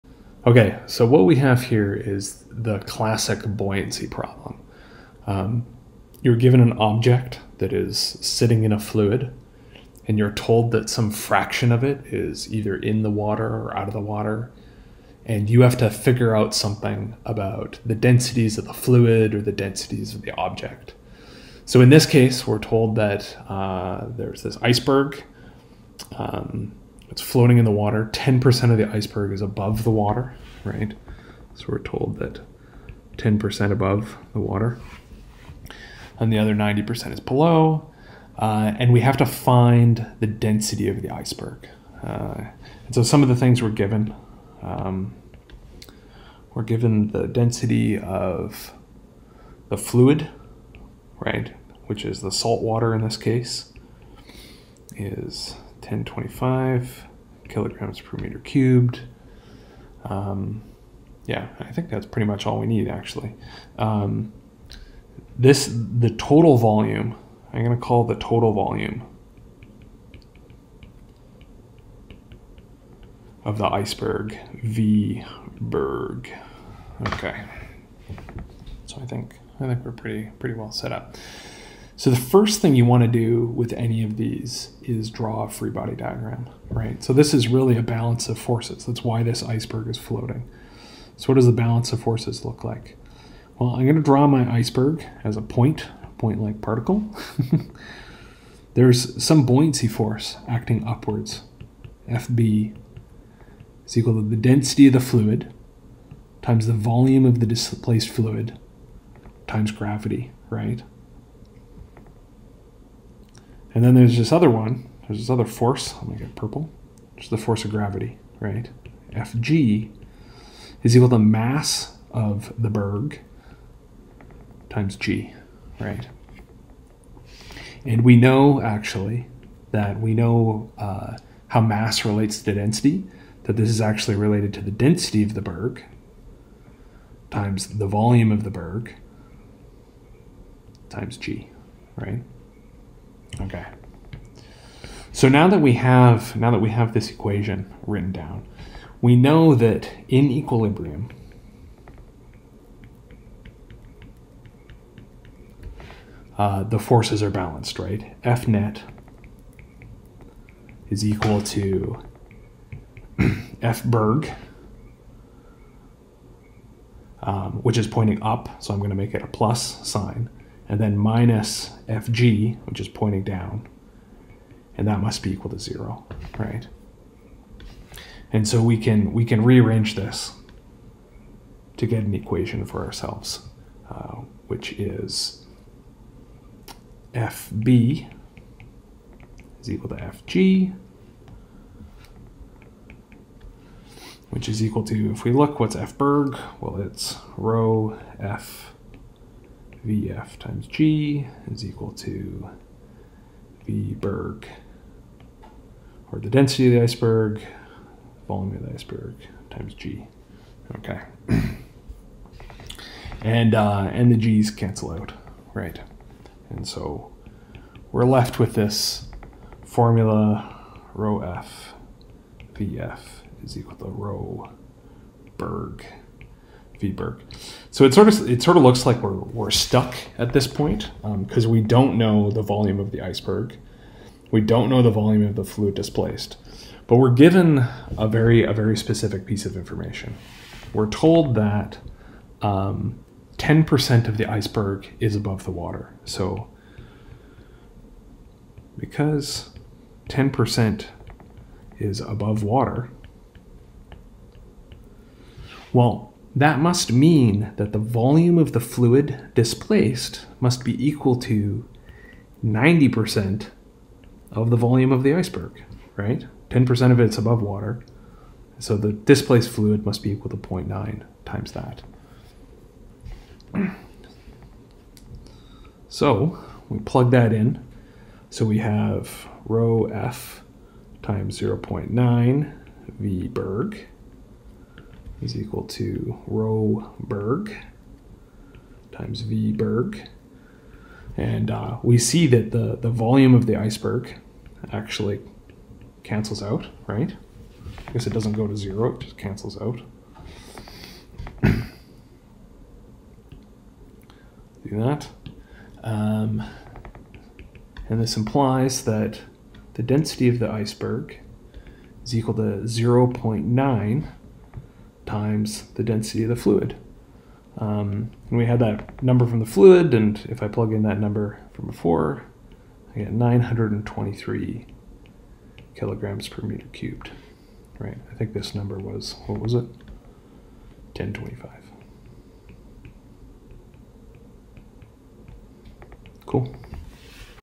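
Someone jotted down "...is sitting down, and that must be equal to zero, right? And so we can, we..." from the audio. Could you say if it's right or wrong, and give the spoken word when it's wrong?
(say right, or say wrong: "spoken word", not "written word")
wrong: "pointing", not "sitting".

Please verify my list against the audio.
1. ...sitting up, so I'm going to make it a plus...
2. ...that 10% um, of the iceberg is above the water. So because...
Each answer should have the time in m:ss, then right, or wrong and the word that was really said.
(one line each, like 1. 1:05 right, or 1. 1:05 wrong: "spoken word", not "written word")
1. 2:47 wrong: "pointing", not "sitting"
2. 4:01 right.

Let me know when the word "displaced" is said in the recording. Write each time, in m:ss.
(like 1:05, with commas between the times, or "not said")
1:47, 3:55, 4:19, 4:28.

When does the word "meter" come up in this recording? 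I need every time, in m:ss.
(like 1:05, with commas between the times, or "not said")
0:58, 5:26.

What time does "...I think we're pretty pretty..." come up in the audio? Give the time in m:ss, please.
1:19.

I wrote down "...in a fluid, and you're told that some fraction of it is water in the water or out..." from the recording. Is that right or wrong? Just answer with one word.
wrong.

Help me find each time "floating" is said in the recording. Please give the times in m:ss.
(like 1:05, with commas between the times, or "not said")
0:27, 1:29.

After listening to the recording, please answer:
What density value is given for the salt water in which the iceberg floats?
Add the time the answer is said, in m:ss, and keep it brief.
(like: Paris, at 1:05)
1025 kg/m³, at 0:55.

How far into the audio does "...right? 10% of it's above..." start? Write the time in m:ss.
4:25.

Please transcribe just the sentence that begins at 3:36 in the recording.
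And so we're left with this formula rho F, Vf is equal to rho Berg.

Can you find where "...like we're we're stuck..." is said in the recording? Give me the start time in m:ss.
3:48.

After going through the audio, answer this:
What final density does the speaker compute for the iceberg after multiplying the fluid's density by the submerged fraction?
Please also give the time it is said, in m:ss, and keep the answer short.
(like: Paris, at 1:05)
923 kg/m³, at 5:23.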